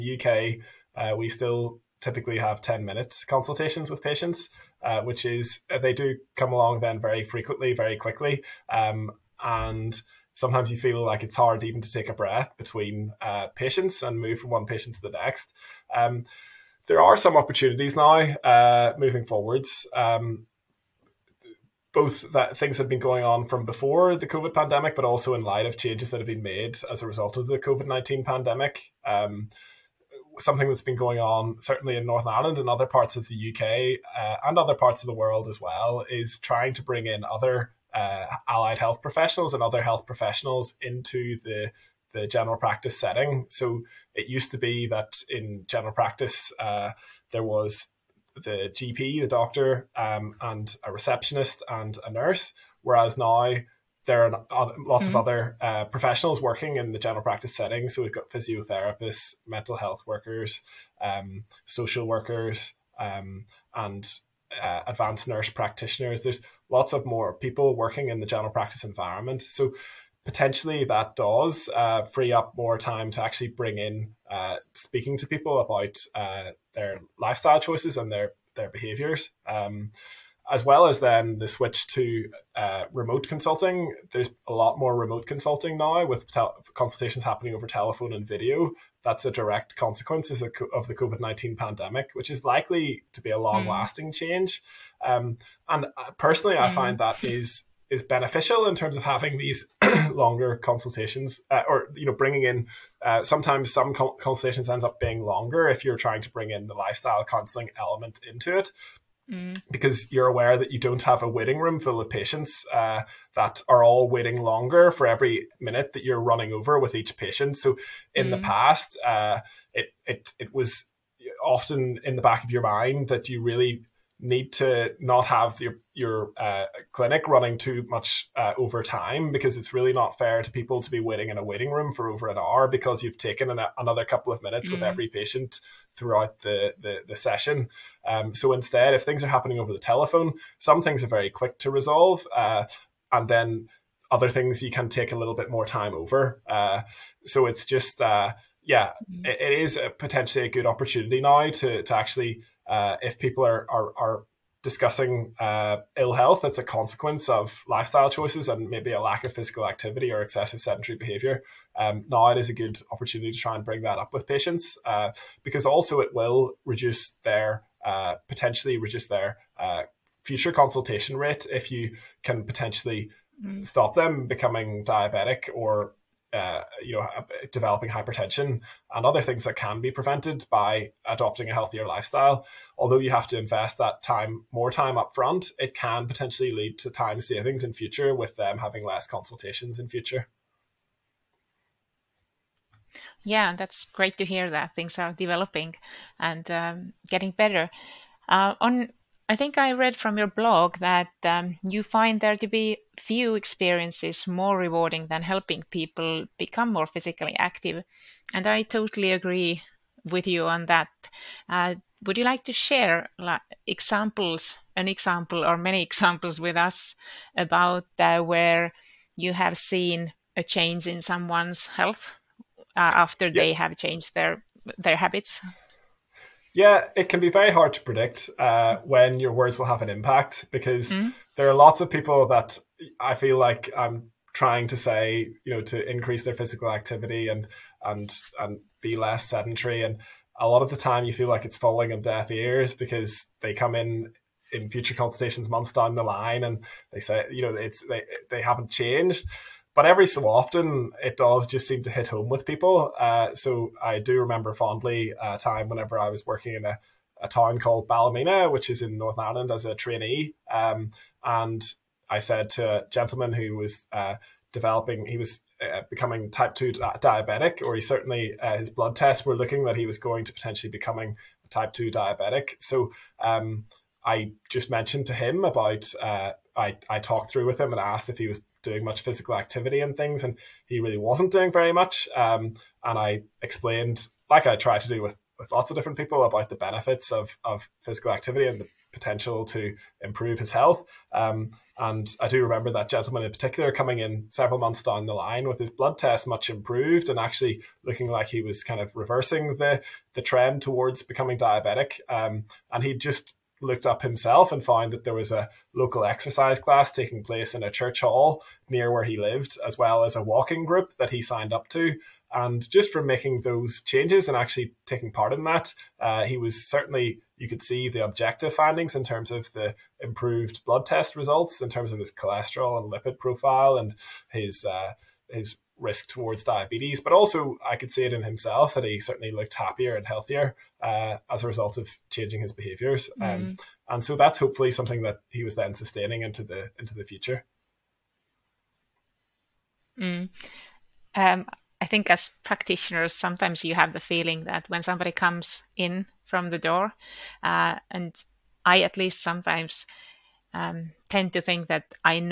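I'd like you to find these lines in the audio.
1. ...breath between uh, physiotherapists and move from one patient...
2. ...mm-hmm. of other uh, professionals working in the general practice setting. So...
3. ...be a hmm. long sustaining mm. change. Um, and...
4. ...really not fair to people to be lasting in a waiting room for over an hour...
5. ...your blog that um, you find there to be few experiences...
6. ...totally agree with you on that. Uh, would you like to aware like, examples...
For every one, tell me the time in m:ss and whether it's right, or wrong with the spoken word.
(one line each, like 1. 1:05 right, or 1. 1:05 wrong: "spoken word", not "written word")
1. 0:12 wrong: "patients", not "physiotherapists"
2. 0:55 right
3. 1:33 wrong: "lasting", not "sustaining"
4. 2:09 wrong: "waiting", not "lasting"
5. 3:20 right
6. 3:28 wrong: "share", not "aware".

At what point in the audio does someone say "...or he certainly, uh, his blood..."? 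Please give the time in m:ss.
4:27.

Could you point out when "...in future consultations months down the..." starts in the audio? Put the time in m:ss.
4:04.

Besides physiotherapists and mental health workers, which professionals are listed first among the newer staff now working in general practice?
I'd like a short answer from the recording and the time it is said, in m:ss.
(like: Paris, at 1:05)
Social workers, at 1:01.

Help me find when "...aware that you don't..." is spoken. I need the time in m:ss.
1:50.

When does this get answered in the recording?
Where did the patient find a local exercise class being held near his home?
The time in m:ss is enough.
5:07.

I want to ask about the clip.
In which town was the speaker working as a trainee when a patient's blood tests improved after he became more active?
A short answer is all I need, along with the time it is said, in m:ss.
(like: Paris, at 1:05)
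Ballymena, at 4:17.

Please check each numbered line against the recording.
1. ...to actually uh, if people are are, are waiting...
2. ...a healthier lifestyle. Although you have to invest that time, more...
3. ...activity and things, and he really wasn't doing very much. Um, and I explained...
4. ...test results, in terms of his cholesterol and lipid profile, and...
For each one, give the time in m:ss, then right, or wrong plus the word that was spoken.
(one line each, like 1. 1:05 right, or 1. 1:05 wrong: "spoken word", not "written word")
1. 2:31 wrong: "discussing", not "waiting"
2. 3:01 right
3. 4:39 right
4. 5:20 right.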